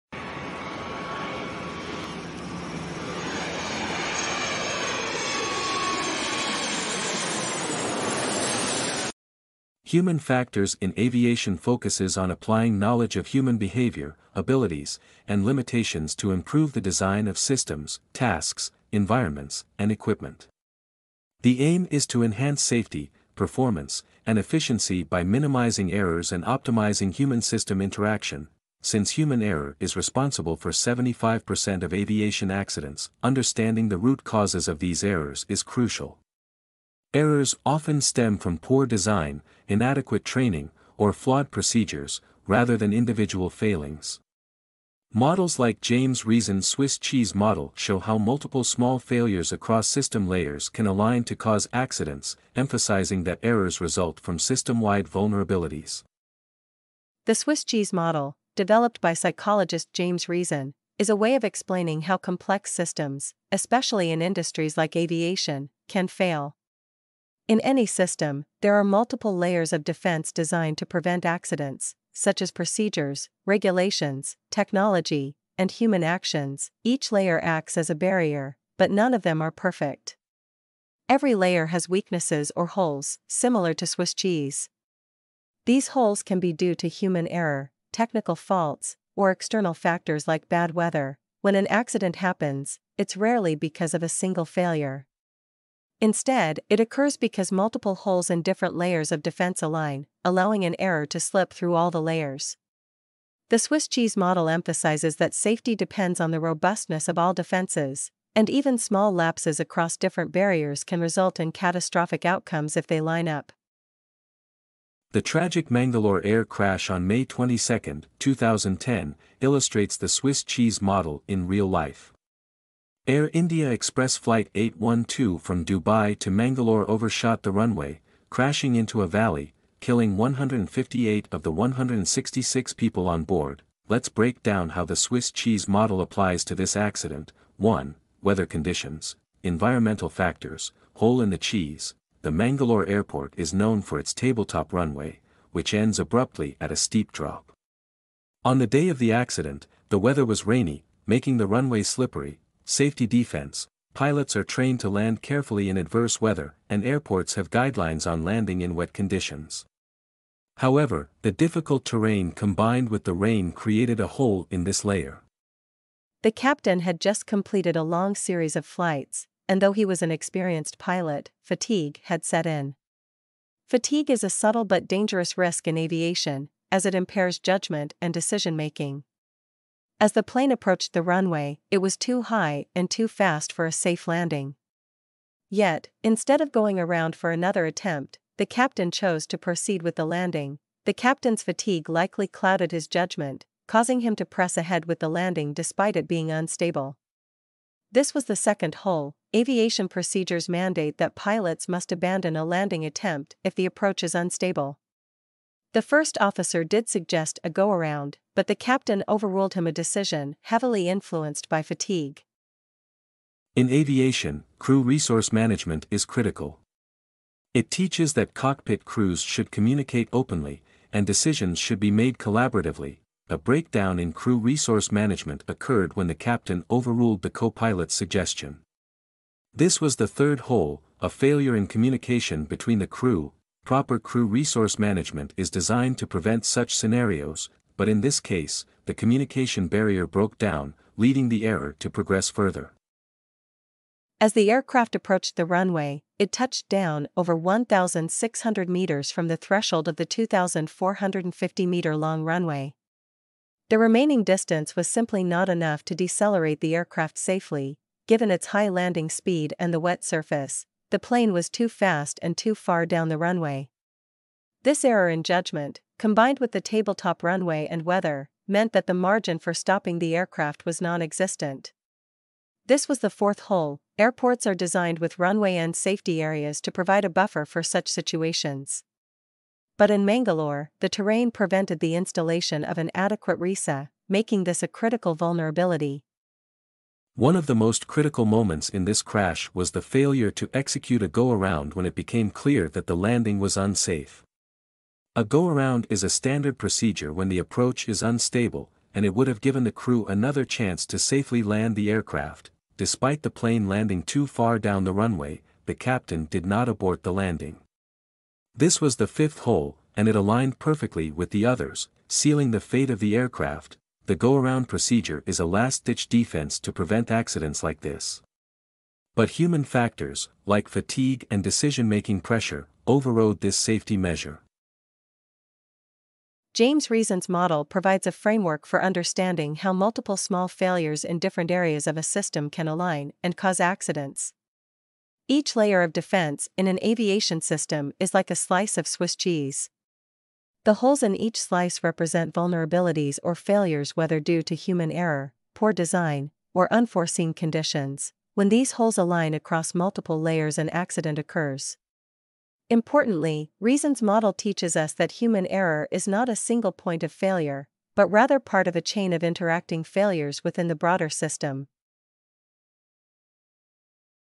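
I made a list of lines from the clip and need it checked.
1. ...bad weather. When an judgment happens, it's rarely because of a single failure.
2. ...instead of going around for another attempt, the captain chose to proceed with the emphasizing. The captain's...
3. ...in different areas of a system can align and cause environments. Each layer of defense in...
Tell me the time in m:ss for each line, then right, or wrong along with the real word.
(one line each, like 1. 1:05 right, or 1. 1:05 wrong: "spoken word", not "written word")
1. 1:30 wrong: "accident", not "judgment"
2. 3:06 wrong: "landing", not "emphasizing"
3. 5:31 wrong: "accidents", not "environments".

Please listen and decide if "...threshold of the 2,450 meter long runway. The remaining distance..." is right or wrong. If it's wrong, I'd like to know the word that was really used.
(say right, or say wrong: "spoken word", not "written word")
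right.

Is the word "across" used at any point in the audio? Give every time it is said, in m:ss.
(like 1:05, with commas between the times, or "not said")
0:49, 1:49, 5:49.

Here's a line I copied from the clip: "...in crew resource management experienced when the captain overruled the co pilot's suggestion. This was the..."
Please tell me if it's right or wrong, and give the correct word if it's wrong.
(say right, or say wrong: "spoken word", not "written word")
wrong: "occurred", not "experienced".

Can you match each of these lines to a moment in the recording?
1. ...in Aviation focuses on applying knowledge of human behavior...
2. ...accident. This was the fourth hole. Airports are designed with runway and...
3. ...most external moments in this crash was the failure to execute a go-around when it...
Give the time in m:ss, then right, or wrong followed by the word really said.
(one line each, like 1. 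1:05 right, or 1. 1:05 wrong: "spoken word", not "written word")
1. 0:10 right
2. 4:31 wrong: "existent", not "accident"
3. 4:47 wrong: "critical", not "external".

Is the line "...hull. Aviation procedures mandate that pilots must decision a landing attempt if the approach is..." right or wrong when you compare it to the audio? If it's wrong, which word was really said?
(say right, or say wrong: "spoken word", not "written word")
wrong: "abandon", not "decision".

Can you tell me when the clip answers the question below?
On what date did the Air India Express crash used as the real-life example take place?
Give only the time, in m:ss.
1:57.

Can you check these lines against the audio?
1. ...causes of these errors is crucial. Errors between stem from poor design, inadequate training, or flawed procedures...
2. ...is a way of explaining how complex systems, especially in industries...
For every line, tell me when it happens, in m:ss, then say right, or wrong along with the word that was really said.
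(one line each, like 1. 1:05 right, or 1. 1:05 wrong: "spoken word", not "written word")
1. 0:34 wrong: "often", not "between"
2. 1:00 right.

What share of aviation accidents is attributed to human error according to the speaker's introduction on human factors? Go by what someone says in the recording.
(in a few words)
75%.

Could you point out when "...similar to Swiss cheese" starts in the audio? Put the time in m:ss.
1:23.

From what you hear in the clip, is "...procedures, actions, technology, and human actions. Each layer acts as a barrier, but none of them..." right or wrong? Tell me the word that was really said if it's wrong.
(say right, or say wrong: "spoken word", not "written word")
wrong: "regulations", not "actions".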